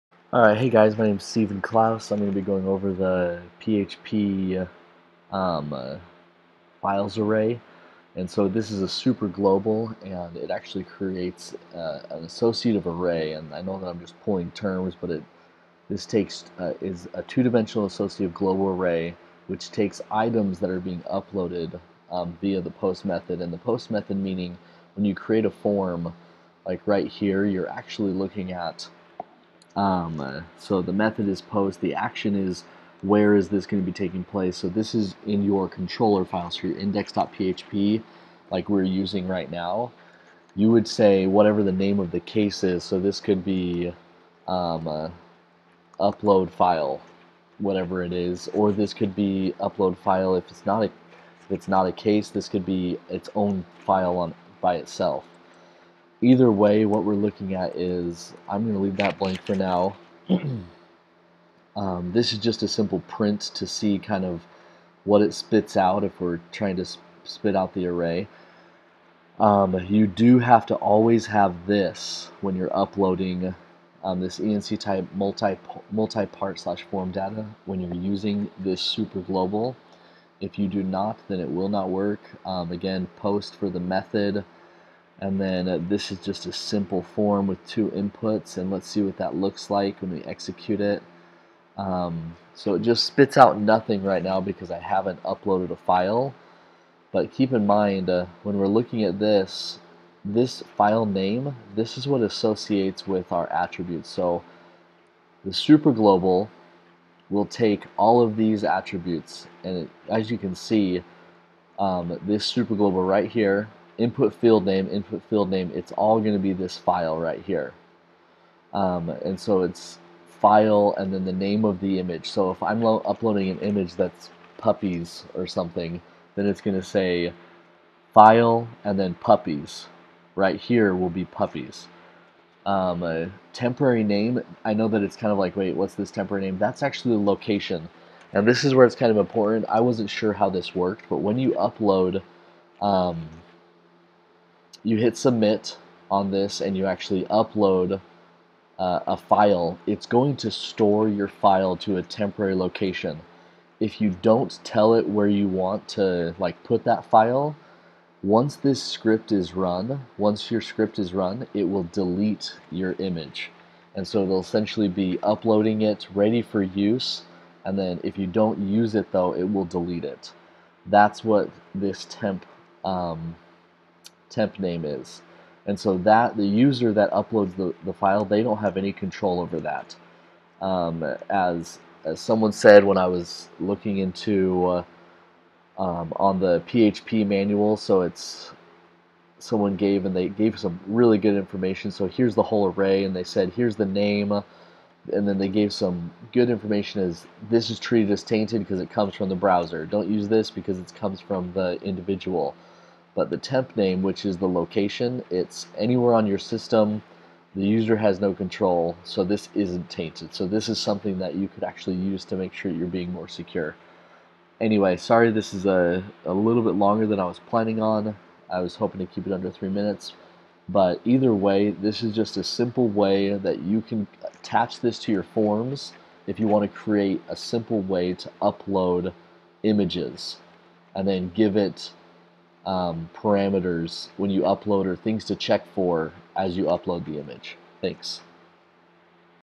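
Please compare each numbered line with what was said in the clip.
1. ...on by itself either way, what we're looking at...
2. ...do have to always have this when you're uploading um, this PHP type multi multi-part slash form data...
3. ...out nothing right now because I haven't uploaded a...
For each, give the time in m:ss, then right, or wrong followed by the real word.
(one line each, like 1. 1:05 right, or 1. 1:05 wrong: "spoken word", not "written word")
1. 0:54 right
2. 1:10 wrong: "ENC", not "PHP"
3. 1:33 right.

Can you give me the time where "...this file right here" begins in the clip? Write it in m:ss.
1:56.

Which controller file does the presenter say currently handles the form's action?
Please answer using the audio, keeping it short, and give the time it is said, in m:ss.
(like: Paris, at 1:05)
index.php, at 0:36.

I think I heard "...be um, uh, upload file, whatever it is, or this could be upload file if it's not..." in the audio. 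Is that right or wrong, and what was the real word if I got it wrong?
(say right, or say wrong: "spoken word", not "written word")
right.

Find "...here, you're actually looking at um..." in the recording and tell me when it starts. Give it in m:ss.
0:27.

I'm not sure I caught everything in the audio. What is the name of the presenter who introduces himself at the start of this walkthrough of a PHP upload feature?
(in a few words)
Steven Clouse.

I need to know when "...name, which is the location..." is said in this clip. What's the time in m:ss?
3:23.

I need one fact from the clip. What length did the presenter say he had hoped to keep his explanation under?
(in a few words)
3 minutes.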